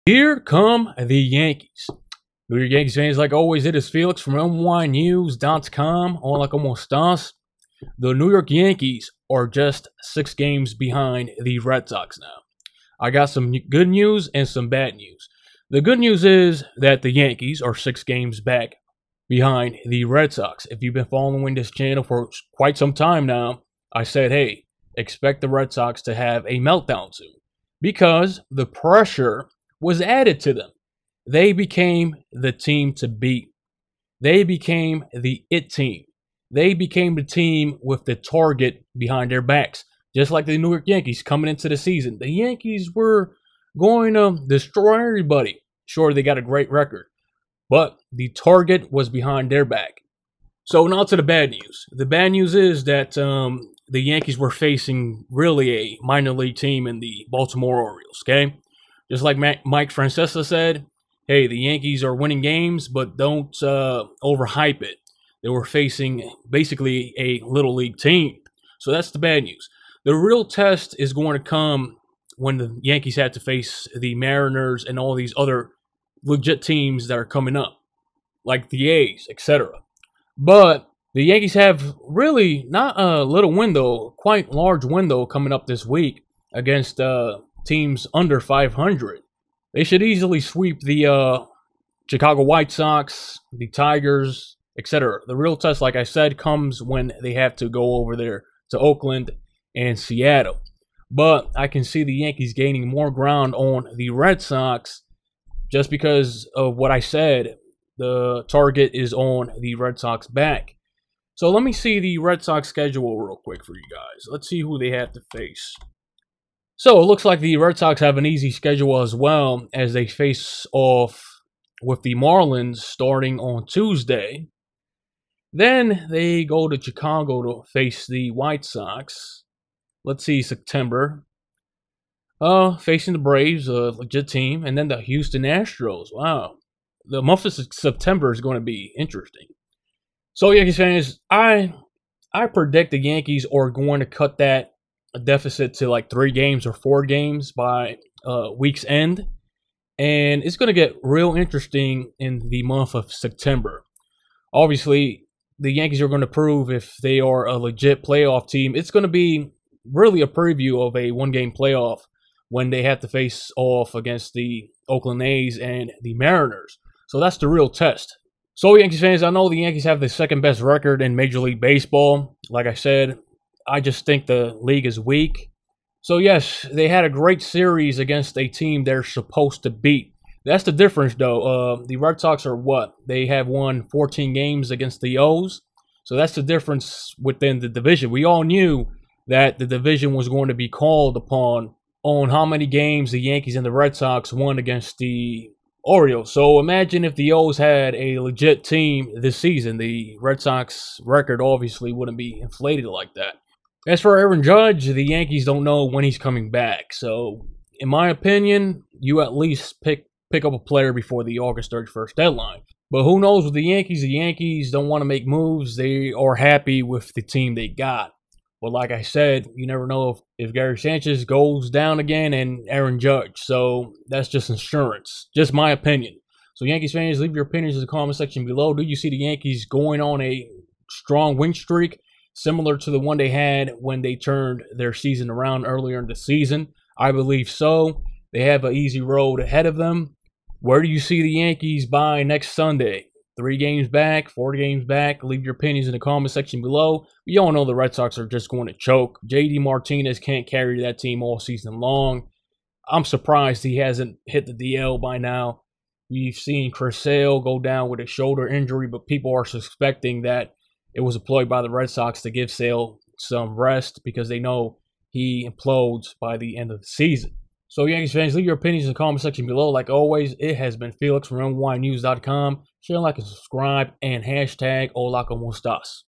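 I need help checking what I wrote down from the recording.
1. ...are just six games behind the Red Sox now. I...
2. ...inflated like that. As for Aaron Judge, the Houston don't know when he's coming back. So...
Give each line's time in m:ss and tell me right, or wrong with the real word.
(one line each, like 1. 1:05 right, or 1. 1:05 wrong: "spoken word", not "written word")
1. 0:09 right
2. 3:22 wrong: "Yankees", not "Houston".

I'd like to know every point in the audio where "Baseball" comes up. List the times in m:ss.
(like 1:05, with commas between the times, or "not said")
2:51.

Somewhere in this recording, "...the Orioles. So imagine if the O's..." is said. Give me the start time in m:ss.
3:14.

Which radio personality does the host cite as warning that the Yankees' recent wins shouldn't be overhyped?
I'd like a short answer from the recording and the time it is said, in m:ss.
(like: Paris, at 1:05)
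Mike Francesa, at 0:59.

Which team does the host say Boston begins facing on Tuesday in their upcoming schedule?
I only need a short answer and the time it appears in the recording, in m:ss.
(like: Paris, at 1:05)
Marlins, at 2:02.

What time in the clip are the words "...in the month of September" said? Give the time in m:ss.
2:32.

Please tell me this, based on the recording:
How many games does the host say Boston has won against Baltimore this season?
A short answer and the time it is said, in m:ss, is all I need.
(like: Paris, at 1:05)
14, at 3:03.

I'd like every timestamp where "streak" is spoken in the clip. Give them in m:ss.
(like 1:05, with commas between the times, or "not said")
3:51.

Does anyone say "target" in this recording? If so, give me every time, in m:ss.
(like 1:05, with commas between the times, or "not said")
0:38, 0:48, 1:48.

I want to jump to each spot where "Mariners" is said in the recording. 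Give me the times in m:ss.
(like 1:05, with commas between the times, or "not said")
1:14, 2:46.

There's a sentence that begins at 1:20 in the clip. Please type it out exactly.
But the Yankees have really not a little window, quite large window coming up this week against uh, teams under 500.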